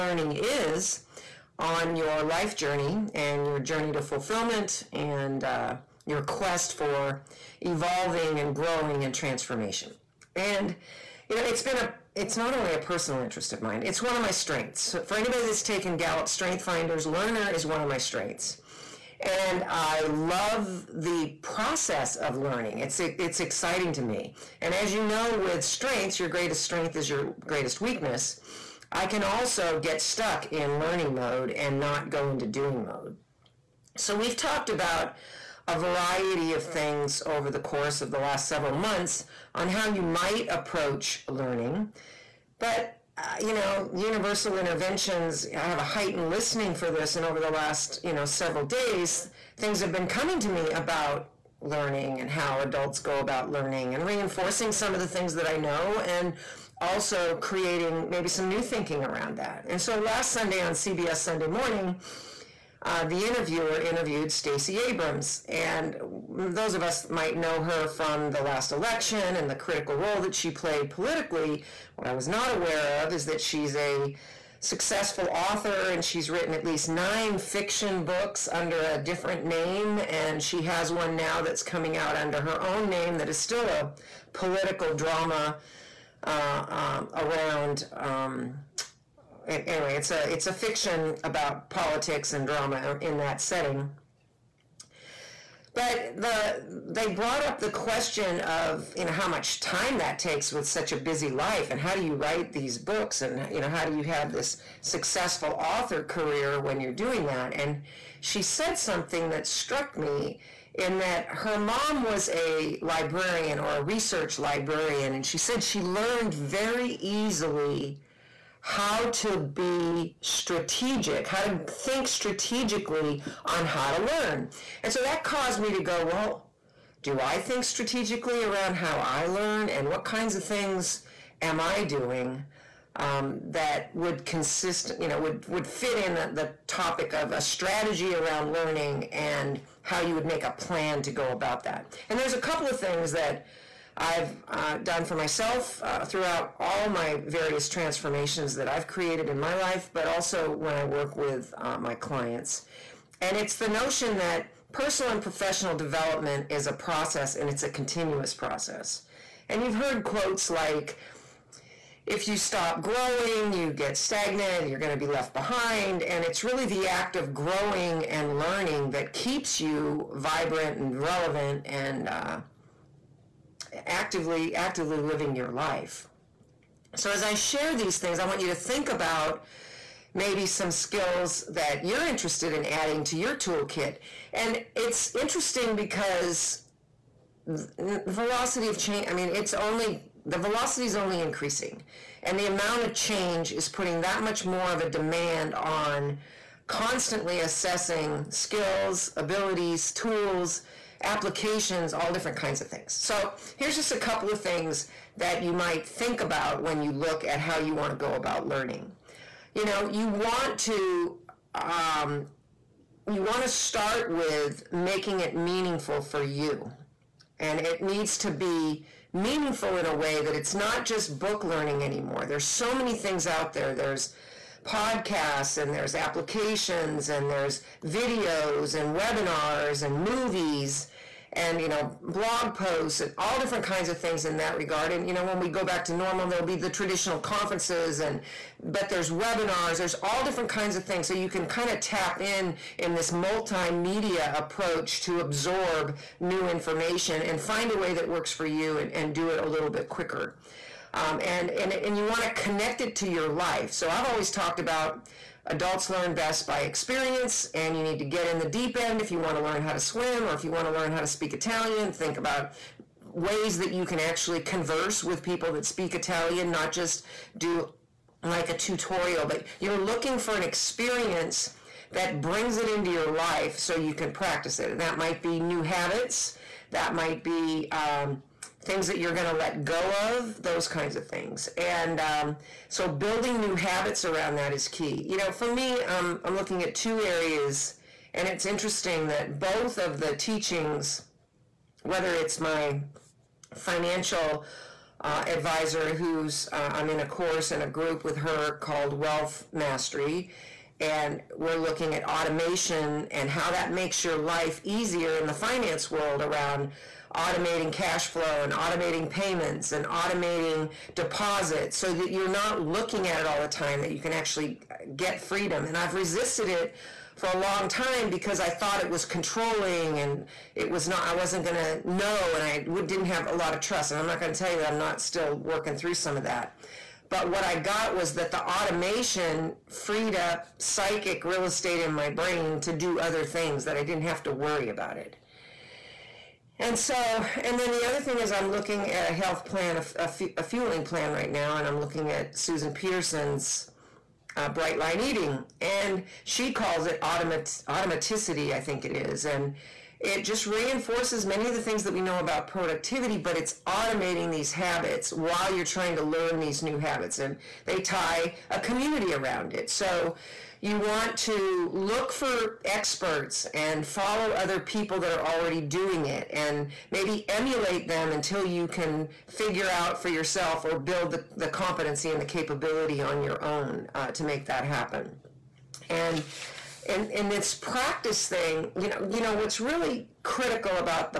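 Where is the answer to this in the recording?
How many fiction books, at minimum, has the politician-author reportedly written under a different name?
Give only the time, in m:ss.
1:16.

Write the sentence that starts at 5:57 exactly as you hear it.
And they tie a community around it.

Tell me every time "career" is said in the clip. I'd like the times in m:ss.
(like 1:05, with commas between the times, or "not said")
1:46.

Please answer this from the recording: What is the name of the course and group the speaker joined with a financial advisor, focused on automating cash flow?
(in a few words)
Wealth Mastery.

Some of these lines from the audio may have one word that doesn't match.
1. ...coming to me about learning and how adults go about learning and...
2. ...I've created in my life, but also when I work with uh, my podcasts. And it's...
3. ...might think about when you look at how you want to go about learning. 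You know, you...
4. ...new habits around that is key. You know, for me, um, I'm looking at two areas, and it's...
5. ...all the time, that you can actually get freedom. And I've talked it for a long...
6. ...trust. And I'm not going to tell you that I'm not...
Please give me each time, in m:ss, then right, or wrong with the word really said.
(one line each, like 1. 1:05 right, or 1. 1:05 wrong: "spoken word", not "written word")
1. 0:50 right
2. 2:28 wrong: "clients", not "podcasts"
3. 3:25 right
4. 4:43 right
5. 5:13 wrong: "resisted", not "talked"
6. 5:23 right.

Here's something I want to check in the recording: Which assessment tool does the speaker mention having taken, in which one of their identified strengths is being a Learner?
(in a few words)
Gallup Strength Finders.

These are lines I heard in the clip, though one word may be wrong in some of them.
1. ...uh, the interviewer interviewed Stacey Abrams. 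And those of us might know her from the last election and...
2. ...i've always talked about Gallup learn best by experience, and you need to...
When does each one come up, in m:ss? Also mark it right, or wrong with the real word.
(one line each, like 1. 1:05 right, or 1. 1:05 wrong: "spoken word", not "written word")
1. 1:02 right
2. 4:13 wrong: "Adults", not "Gallup".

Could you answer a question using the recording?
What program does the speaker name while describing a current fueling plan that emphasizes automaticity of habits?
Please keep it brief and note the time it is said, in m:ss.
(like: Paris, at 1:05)
Bright Line Eating, at 5:44.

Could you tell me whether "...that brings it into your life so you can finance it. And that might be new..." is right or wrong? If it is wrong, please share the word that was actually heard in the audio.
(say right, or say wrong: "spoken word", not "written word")
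wrong: "practice", not "finance".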